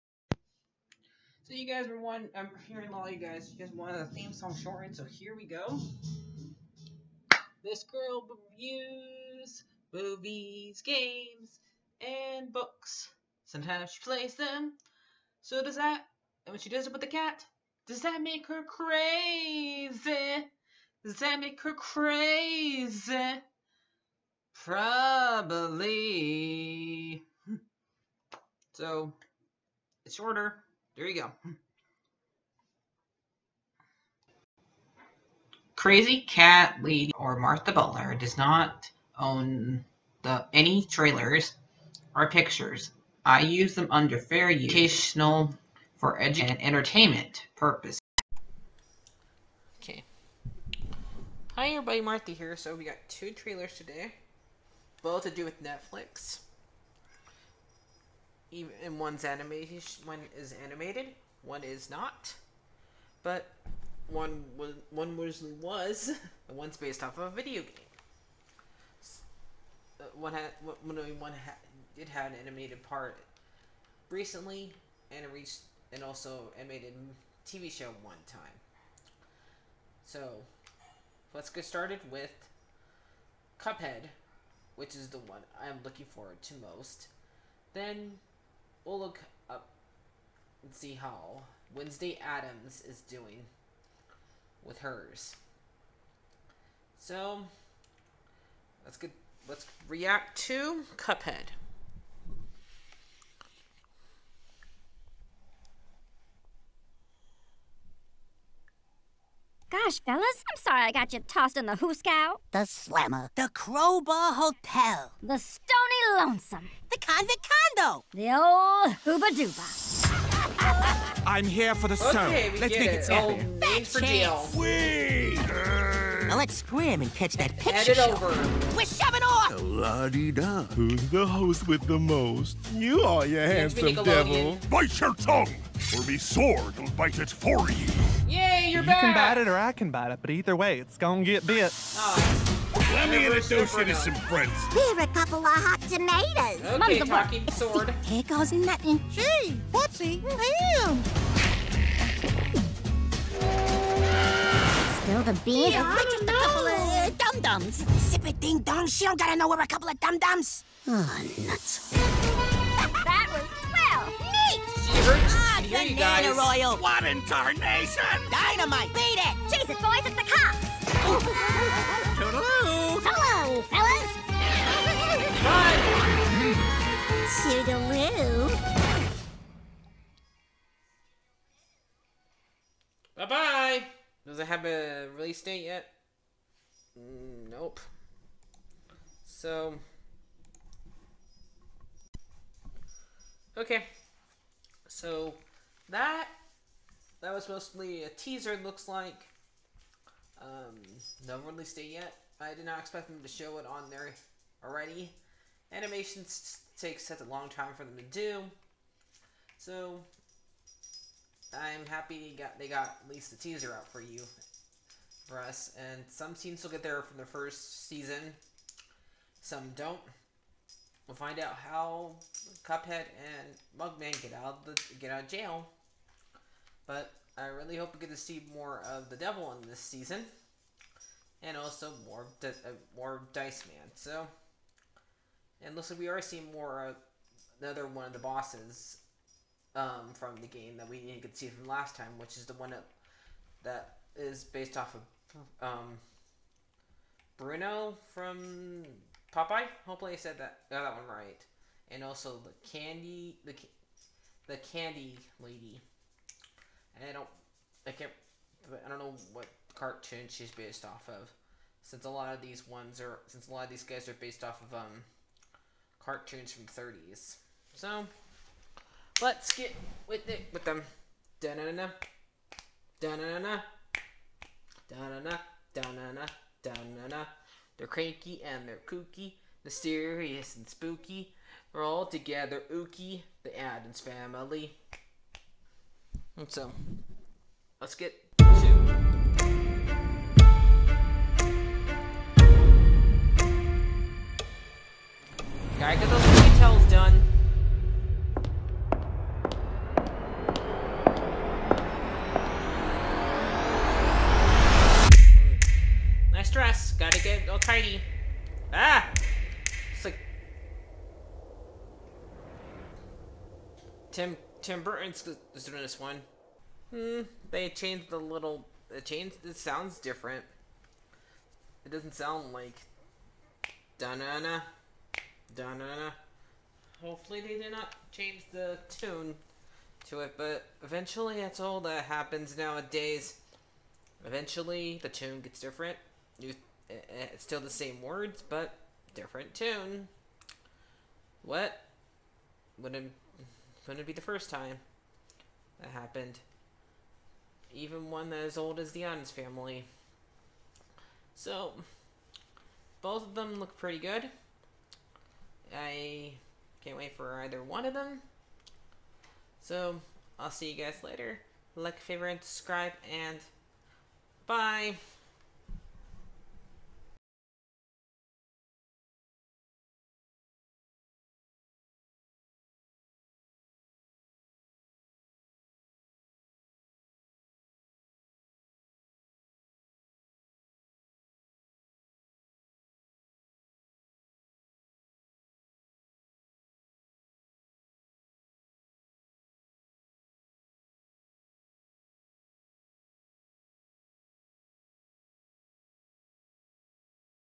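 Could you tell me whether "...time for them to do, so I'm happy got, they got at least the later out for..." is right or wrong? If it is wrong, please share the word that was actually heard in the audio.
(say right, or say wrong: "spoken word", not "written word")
wrong: "teaser", not "later".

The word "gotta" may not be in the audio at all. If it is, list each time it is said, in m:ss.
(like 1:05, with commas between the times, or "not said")
2:39, 4:55.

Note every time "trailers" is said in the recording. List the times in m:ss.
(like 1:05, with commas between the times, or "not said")
0:40, 0:53.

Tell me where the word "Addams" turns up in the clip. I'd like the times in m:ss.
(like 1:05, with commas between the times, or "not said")
1:32, 4:43, 5:49.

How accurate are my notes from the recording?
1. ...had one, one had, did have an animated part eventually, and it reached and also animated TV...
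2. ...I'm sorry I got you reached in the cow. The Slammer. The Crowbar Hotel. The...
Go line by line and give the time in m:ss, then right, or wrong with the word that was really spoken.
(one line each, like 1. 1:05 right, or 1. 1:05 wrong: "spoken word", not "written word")
1. 1:10 wrong: "recently", not "eventually"
2. 1:50 wrong: "tossed", not "reached".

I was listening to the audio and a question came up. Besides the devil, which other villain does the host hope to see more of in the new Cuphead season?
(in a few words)
Dice Man.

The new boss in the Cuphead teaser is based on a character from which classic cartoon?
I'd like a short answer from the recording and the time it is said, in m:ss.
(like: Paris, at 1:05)
Popeye, at 4:09.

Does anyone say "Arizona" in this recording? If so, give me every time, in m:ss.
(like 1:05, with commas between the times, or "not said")
not said.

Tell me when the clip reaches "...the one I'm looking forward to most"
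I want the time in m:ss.
1:25.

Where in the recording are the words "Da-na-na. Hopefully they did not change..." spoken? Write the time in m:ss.
5:25.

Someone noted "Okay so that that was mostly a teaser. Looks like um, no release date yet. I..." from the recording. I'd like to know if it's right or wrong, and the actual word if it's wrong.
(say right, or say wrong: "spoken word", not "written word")
right.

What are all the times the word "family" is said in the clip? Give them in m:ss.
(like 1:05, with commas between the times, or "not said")
4:43, 5:49.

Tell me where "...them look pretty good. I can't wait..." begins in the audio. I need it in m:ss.
5:53.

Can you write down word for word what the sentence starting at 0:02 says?
I'm um, hearing all you guys.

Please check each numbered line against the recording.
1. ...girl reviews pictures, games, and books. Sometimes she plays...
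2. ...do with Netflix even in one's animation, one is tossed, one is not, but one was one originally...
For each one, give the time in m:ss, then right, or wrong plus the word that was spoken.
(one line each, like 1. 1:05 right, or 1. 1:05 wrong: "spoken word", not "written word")
1. 0:07 wrong: "movies", not "pictures"
2. 0:55 wrong: "animated", not "tossed".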